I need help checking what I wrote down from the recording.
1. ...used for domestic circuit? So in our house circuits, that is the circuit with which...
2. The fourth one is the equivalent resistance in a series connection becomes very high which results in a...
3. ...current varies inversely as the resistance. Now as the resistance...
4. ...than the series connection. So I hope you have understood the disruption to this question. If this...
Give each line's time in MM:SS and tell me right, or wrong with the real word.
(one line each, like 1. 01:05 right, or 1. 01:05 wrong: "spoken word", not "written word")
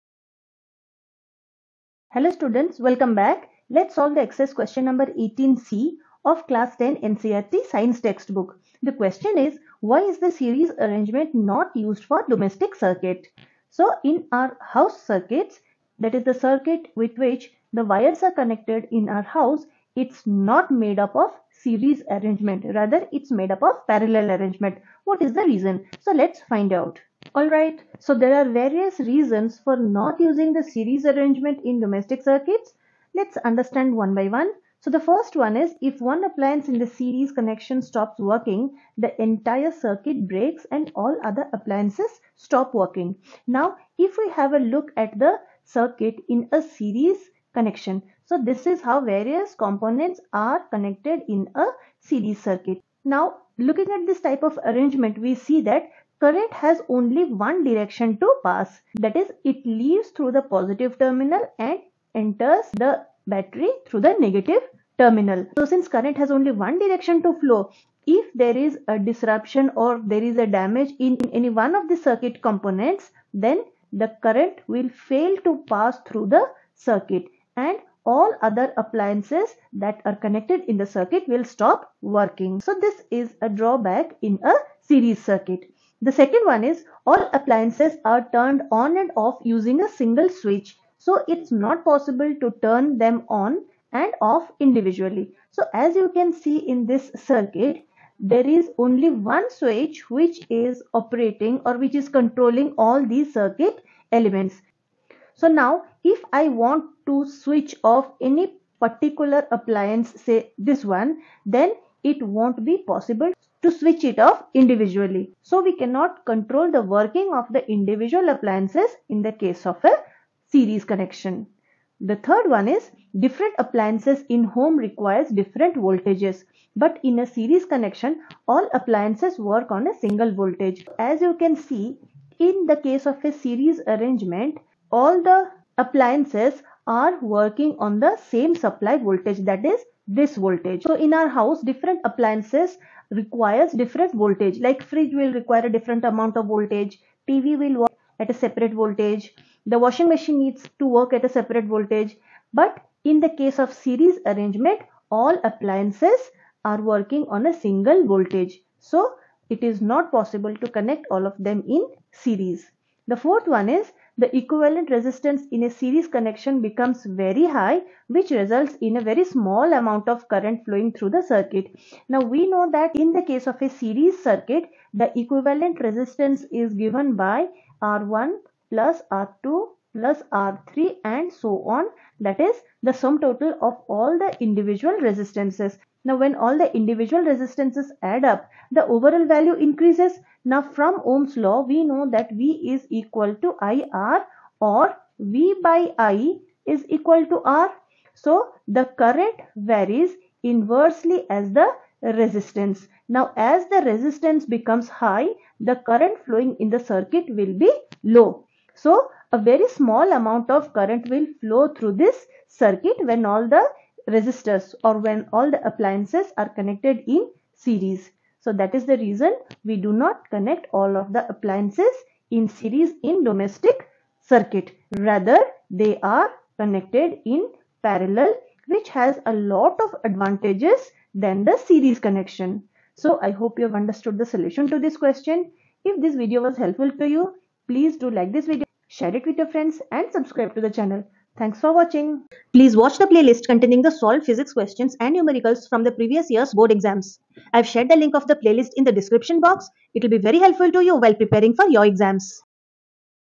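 1. 00:11 right
2. 02:43 right
3. 03:18 right
4. 03:51 wrong: "solution", not "disruption".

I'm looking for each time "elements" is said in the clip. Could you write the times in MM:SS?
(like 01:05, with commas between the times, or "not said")
01:44.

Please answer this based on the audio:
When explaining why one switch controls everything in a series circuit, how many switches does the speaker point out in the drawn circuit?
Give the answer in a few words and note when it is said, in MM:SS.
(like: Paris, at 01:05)
1, at 01:38.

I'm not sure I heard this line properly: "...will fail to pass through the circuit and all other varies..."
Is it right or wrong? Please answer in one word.
wrong.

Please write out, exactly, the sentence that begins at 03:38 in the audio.
So that is the reason we do not connect all of the appliances in series in domestic circuit.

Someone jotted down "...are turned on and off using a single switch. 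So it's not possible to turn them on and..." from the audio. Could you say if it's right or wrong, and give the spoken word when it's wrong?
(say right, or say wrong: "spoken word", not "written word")
right.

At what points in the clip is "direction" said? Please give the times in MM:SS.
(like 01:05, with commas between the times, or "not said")
00:57, 01:06.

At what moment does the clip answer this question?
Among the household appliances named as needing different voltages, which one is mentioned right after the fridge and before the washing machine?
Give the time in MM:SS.
02:27.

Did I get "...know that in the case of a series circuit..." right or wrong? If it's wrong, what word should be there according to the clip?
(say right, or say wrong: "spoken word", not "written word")
right.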